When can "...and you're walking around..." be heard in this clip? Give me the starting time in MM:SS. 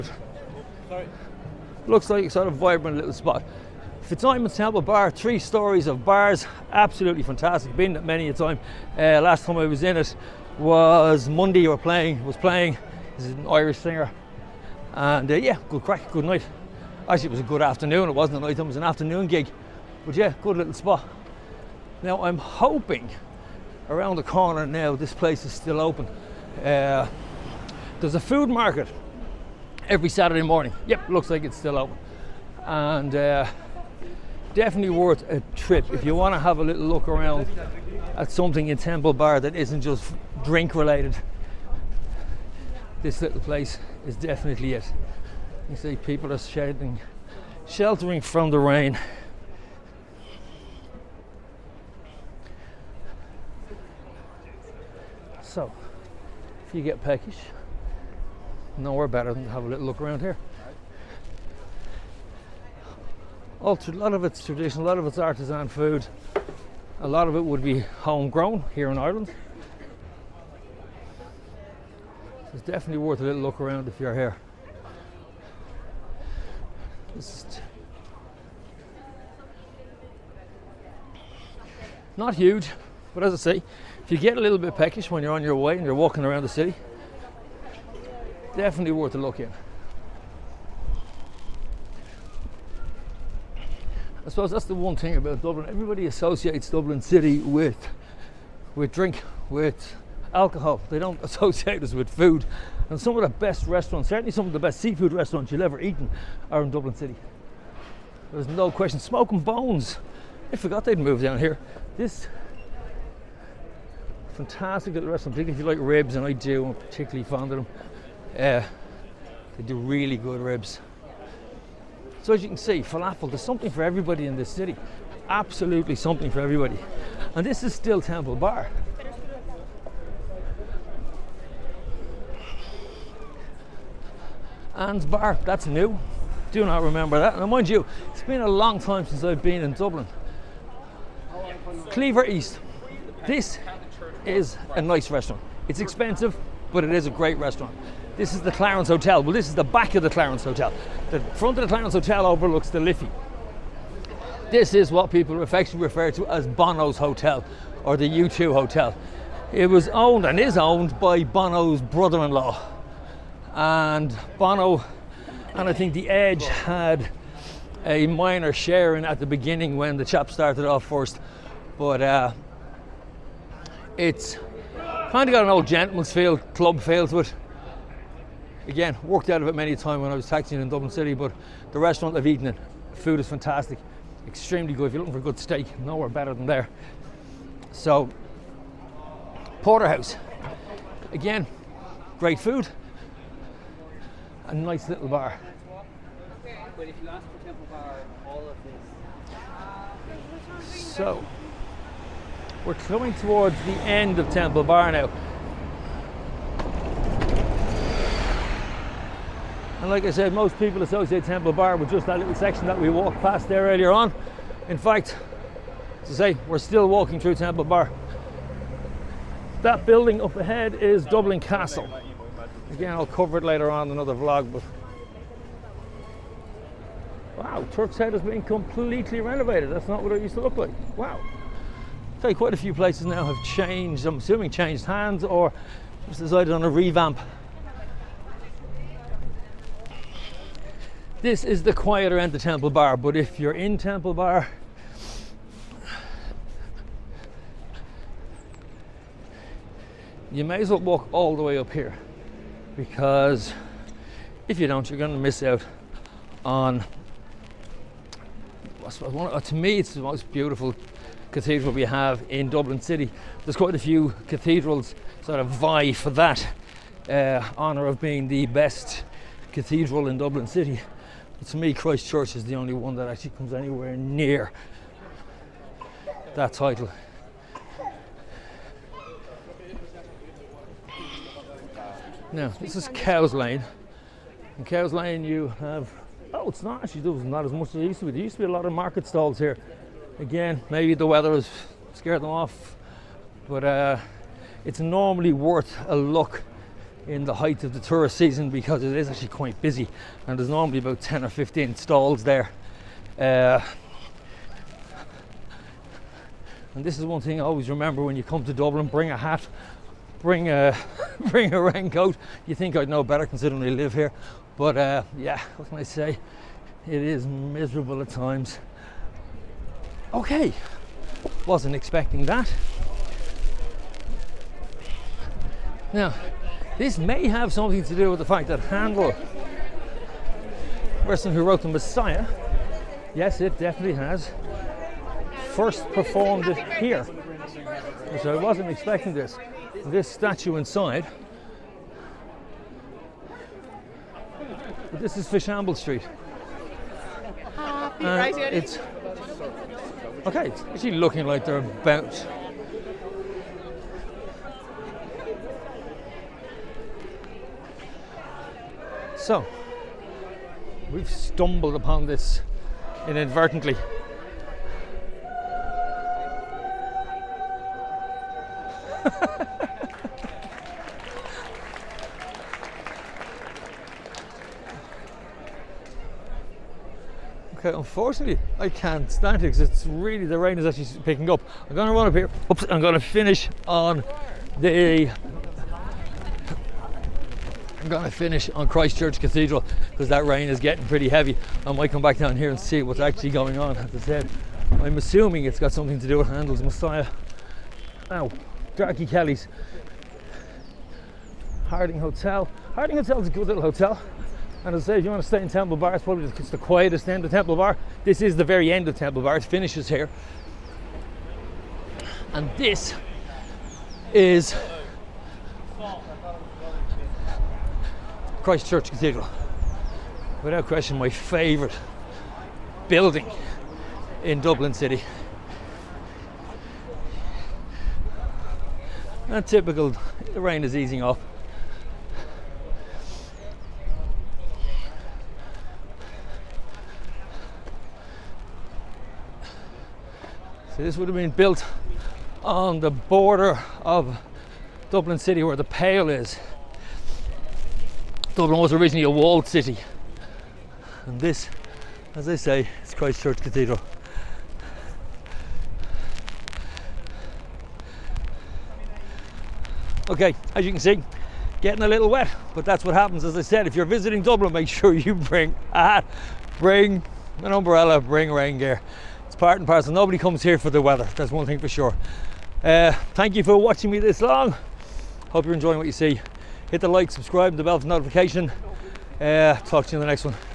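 01:25.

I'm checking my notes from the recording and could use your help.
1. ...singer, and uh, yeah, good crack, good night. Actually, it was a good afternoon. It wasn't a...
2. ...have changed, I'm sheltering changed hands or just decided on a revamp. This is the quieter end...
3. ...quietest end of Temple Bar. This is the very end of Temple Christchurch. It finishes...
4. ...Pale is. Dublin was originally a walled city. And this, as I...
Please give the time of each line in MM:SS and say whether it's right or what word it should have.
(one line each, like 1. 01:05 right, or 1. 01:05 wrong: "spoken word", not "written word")
1. 00:13 right
2. 03:53 wrong: "assuming", not "sheltering"
3. 06:46 wrong: "Bar", not "Christchurch"
4. 07:25 right.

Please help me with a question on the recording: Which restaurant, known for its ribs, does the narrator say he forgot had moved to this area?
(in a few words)
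Smoking Bones.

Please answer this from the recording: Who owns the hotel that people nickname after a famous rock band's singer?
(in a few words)
Bono's brother-in-law.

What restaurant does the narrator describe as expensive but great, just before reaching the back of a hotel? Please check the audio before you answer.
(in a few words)
Cleaver East.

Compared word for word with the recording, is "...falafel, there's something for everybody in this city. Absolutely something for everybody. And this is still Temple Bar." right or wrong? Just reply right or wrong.
right.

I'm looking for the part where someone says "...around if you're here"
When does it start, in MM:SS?
01:13.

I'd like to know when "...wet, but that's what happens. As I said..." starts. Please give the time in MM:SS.
07:42.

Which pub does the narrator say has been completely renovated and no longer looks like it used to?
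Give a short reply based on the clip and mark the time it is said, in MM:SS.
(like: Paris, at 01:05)
Turk's Head, at 03:47.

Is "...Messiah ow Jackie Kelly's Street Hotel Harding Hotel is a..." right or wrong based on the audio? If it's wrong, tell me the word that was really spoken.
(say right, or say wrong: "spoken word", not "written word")
wrong: "Harding", not "Street".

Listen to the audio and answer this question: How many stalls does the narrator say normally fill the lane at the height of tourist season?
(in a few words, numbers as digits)
10 or 15.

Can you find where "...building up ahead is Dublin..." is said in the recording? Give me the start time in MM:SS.
03:39.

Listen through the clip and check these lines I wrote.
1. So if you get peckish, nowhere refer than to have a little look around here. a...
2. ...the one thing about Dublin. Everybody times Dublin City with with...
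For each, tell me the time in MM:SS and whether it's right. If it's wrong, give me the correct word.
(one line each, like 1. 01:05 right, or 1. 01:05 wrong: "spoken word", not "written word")
1. 00:55 wrong: "better", not "refer"
2. 01:34 wrong: "associates", not "times".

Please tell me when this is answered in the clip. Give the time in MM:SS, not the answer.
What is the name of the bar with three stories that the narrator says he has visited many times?
00:04.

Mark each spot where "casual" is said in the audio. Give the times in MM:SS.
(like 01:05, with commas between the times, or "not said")
not said.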